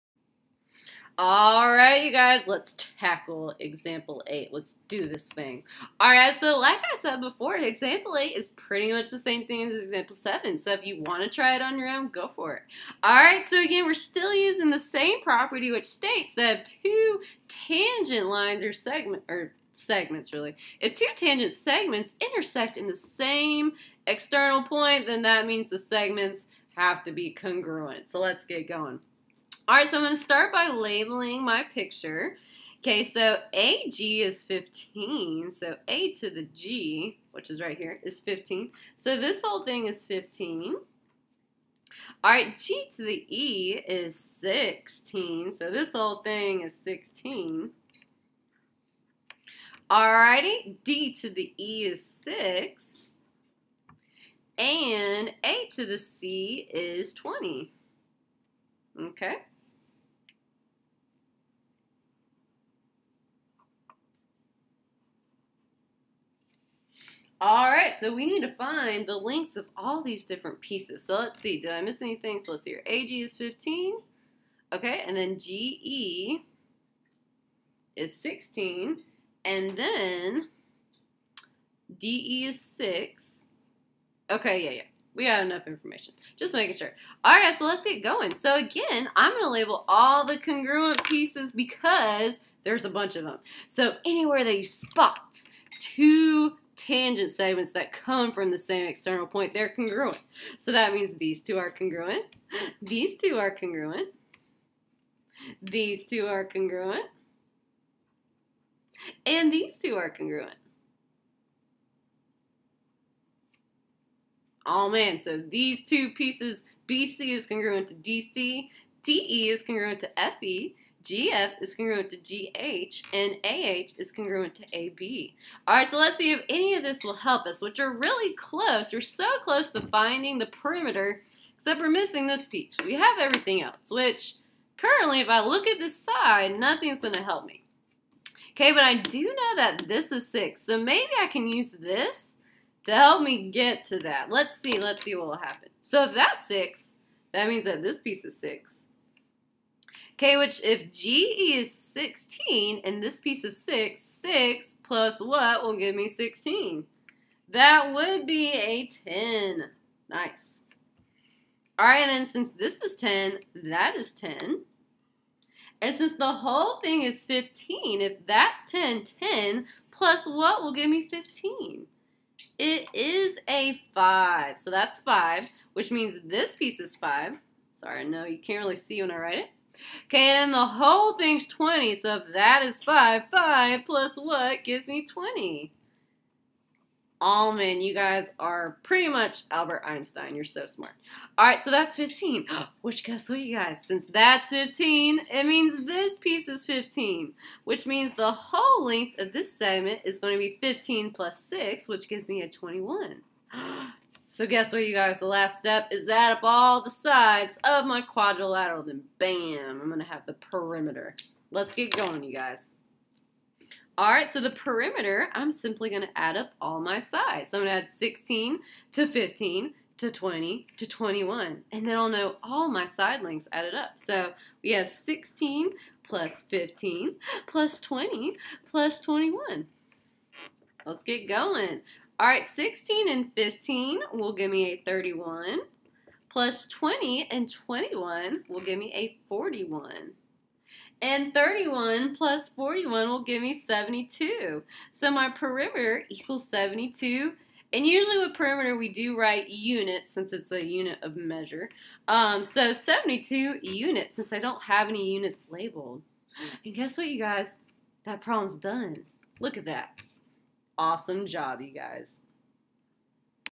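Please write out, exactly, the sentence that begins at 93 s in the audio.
So anywhere that you spot two tangent segments that come from the same external point, they're congruent.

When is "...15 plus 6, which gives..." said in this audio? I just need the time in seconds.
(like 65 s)
200 s.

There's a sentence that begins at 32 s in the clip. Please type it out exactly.
Okay, so AG is 15, so A to the G, which is right here, is 15.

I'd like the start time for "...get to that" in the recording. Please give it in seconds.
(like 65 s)
143 s.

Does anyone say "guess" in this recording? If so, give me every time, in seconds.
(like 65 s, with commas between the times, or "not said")
193 s, 204 s, 256 s.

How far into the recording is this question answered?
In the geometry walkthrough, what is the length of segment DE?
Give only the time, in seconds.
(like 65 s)
50 s.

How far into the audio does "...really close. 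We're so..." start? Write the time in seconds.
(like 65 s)
127 s.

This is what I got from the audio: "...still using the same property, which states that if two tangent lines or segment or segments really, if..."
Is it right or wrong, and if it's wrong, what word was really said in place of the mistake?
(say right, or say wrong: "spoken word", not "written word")
right.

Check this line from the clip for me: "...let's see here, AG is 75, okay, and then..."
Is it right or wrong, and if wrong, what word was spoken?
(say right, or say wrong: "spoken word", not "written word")
wrong: "15", not "75".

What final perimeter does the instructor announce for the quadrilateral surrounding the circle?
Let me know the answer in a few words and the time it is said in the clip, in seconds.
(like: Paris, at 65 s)
72 units, at 252 s.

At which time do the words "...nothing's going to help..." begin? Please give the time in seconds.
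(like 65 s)
136 s.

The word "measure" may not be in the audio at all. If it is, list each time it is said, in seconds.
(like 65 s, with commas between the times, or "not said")
251 s.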